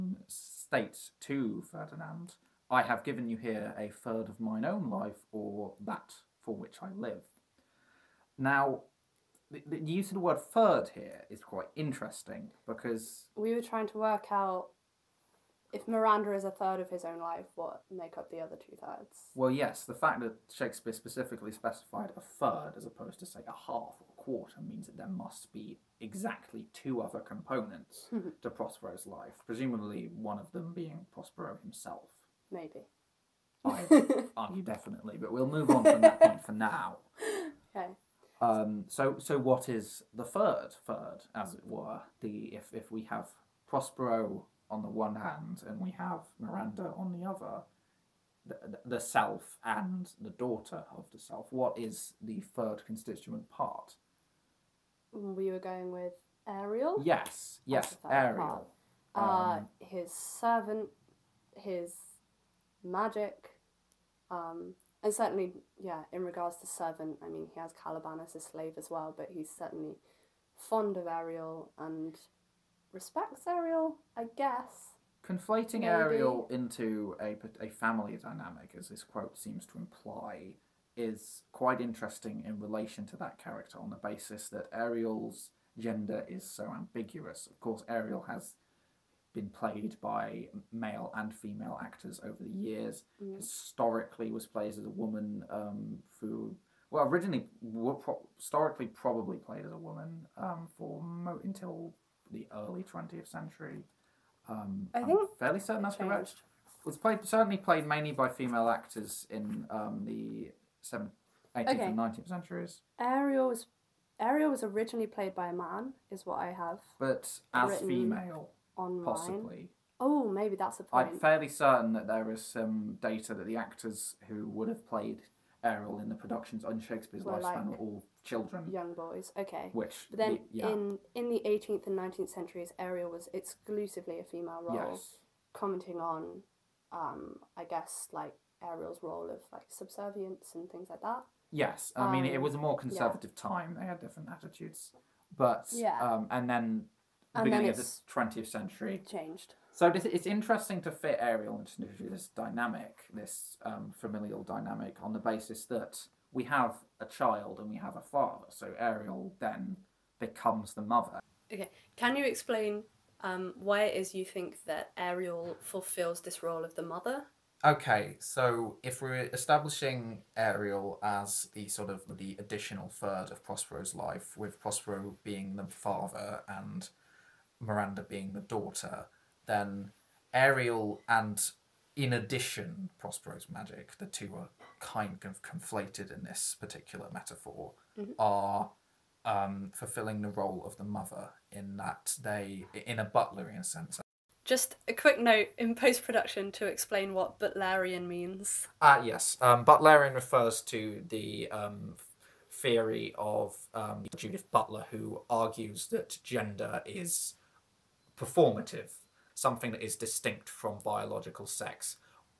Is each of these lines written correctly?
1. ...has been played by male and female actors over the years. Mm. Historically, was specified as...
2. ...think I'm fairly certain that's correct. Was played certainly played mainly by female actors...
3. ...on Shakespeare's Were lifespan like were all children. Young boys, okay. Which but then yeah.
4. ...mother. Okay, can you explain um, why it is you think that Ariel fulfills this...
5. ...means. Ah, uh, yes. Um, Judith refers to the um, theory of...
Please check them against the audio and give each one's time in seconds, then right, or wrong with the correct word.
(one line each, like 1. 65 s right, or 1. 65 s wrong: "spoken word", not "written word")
1. 88 s wrong: "played", not "specified"
2. 105 s right
3. 126 s right
4. 160 s right
5. 198 s wrong: "Butlerian", not "Judith".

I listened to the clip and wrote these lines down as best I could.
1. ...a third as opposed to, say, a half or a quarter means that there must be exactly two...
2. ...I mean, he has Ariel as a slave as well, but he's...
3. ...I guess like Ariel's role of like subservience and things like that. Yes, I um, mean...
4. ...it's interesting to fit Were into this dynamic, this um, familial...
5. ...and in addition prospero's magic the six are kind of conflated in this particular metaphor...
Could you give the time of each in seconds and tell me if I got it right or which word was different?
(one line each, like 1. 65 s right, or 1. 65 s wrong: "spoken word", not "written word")
1. 22 s right
2. 67 s wrong: "Caliban", not "Ariel"
3. 137 s right
4. 149 s wrong: "Ariel", not "Were"
5. 181 s wrong: "two", not "six".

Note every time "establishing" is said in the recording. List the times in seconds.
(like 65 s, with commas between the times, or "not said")
169 s.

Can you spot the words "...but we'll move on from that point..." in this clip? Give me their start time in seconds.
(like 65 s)
35 s.